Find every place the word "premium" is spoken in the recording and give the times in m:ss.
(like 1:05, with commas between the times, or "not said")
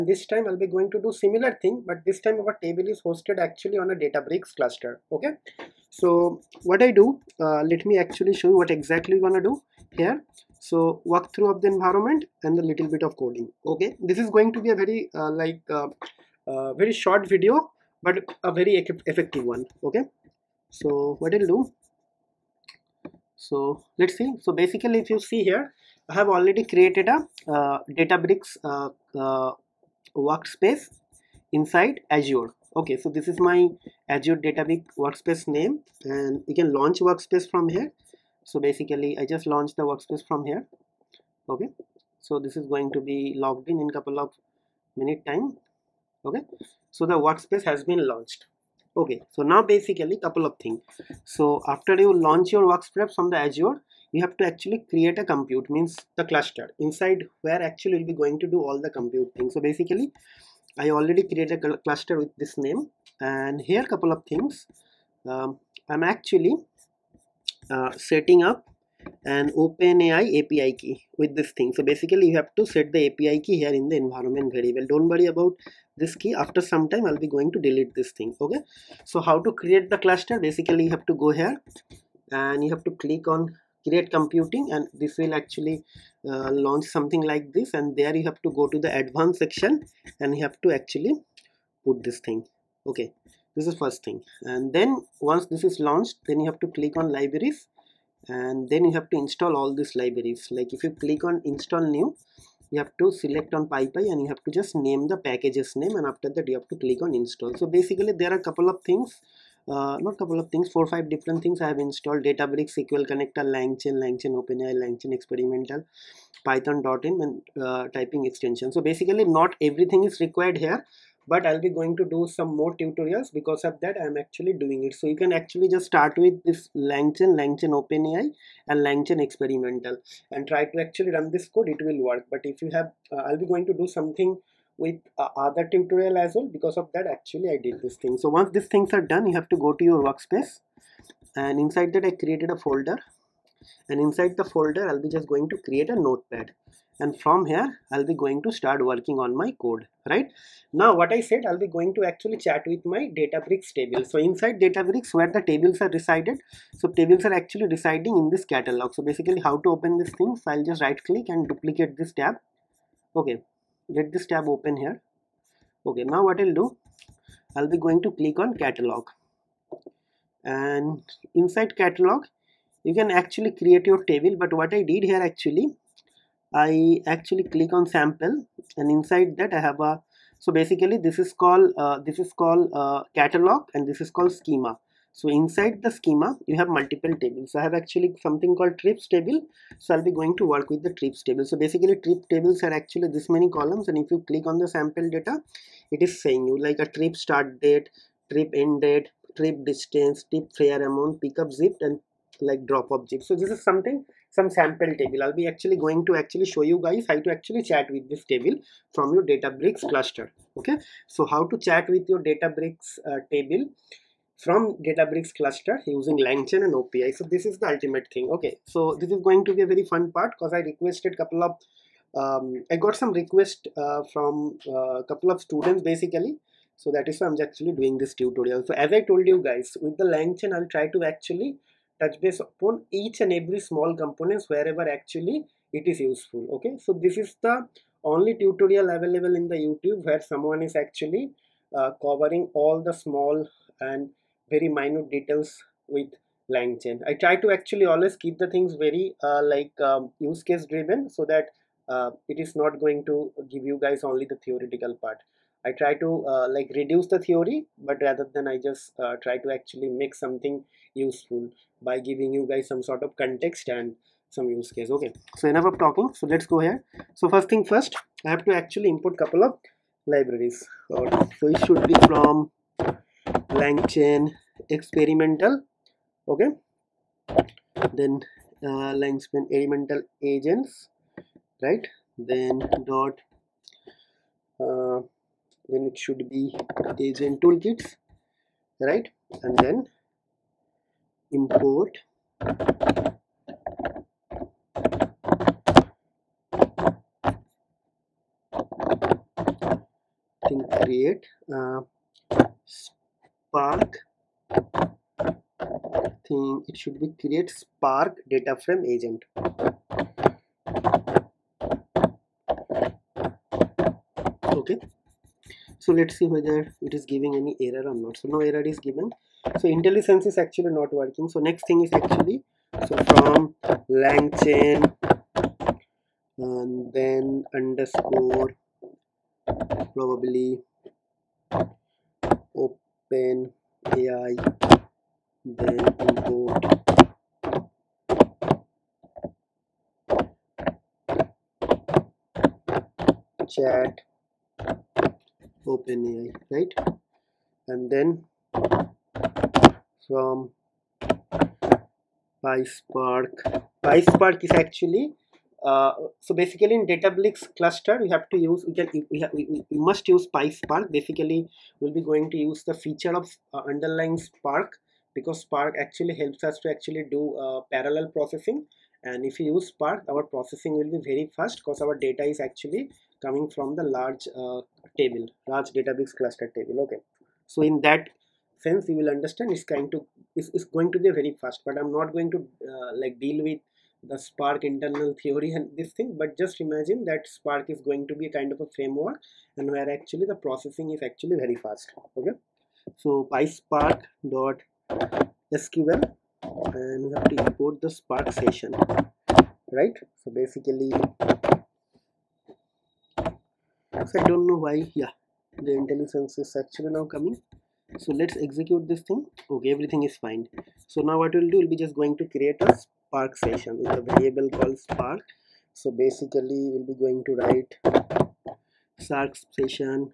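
not said.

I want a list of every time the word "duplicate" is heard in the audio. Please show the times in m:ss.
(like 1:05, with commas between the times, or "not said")
2:41.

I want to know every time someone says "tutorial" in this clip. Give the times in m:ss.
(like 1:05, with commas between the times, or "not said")
2:02, 2:15, 3:48, 3:58.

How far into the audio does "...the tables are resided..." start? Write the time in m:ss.
2:35.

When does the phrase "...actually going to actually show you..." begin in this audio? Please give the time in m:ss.
3:25.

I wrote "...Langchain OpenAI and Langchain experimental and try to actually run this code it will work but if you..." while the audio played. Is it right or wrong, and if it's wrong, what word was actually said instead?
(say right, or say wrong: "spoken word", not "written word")
right.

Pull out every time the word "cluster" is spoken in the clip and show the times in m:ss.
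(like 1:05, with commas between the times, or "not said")
0:04, 0:56, 1:01, 1:19, 3:29, 3:35, 5:57, 6:16.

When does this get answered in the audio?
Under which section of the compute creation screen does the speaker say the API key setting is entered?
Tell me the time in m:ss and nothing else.
1:28.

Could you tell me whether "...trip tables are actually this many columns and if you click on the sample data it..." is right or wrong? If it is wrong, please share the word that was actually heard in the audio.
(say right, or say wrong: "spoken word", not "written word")
right.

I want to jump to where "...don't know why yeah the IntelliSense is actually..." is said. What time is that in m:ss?
6:44.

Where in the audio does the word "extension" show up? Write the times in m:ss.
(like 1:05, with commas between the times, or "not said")
1:58.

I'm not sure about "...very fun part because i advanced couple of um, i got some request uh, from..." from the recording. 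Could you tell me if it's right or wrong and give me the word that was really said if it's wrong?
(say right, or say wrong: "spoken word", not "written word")
wrong: "requested", not "advanced".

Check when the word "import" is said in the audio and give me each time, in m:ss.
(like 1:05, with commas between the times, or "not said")
4:28, 4:51, 5:36, 6:37.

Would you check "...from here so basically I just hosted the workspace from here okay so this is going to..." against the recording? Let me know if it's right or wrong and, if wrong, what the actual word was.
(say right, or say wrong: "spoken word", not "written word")
wrong: "launched", not "hosted".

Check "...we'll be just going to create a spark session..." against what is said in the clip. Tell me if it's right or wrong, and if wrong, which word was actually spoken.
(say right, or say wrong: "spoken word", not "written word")
right.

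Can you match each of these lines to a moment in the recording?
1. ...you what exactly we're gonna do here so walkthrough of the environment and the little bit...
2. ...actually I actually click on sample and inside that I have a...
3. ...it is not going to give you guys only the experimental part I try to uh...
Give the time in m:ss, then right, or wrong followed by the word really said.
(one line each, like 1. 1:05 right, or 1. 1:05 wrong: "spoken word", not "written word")
1. 0:08 right
2. 2:55 right
3. 4:12 wrong: "theoretical", not "experimental".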